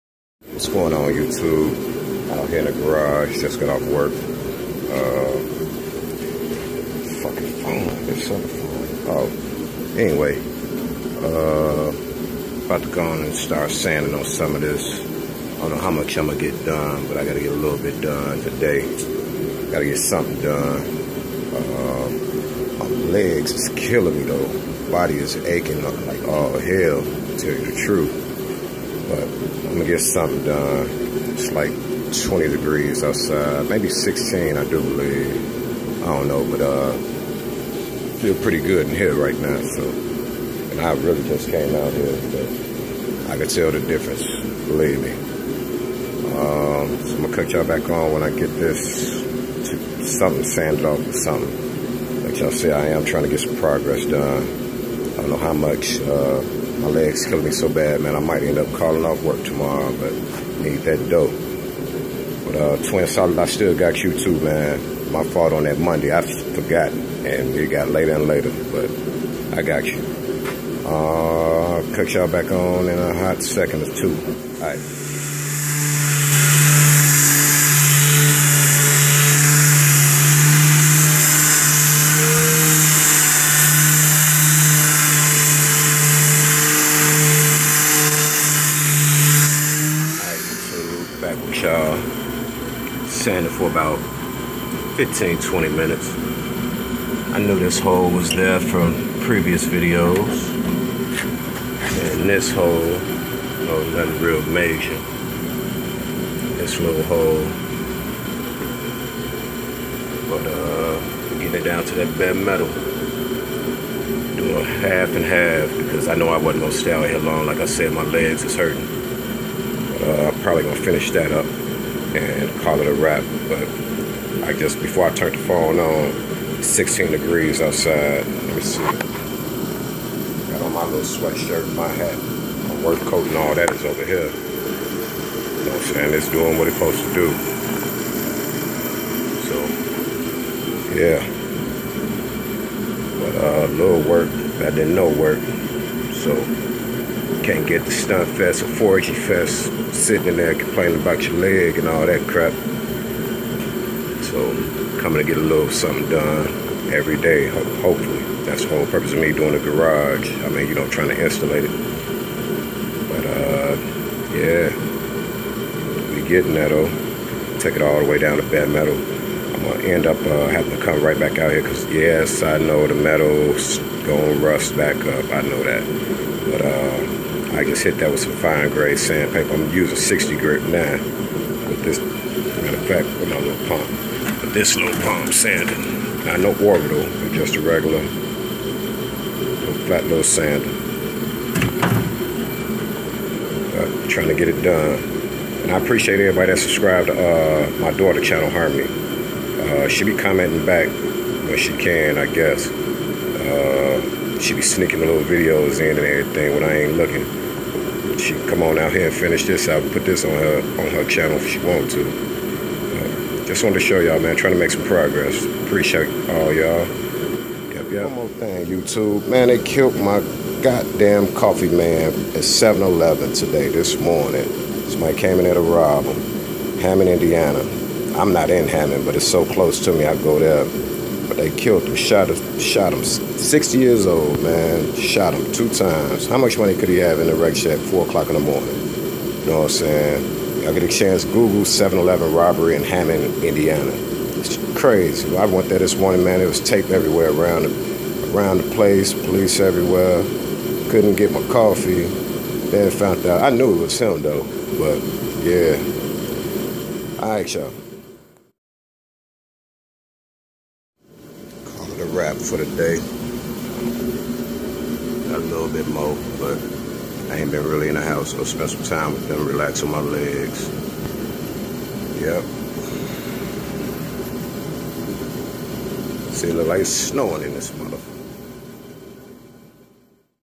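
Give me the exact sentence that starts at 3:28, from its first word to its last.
She come on out here and finish this out, put this on her on her channel if she want to.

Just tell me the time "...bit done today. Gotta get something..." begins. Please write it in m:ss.
0:17.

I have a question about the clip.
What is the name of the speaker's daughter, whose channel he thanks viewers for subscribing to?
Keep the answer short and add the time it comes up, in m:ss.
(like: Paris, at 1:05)
Harmoni, at 3:18.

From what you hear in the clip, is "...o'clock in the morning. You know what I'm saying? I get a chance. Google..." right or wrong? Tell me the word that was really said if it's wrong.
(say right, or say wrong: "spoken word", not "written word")
right.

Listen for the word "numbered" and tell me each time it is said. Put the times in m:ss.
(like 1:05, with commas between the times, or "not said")
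not said.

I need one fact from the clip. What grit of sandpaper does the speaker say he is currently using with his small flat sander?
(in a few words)
60.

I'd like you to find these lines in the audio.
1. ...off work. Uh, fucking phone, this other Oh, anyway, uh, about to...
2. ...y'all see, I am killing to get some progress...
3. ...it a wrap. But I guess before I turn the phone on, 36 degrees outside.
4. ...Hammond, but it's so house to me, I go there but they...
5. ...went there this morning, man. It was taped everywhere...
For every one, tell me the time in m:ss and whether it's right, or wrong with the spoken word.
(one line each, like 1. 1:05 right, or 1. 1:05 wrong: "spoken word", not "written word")
1. 0:03 right
2. 0:52 wrong: "trying", not "killing"
3. 2:02 wrong: "16", not "36"
4. 3:48 wrong: "close", not "house"
5. 4:05 right.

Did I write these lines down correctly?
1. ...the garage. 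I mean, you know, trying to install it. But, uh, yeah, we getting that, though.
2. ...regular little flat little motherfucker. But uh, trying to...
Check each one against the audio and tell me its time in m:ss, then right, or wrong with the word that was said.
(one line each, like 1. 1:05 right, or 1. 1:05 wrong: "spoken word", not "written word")
1. 2:39 right
2. 3:07 wrong: "sander", not "motherfucker".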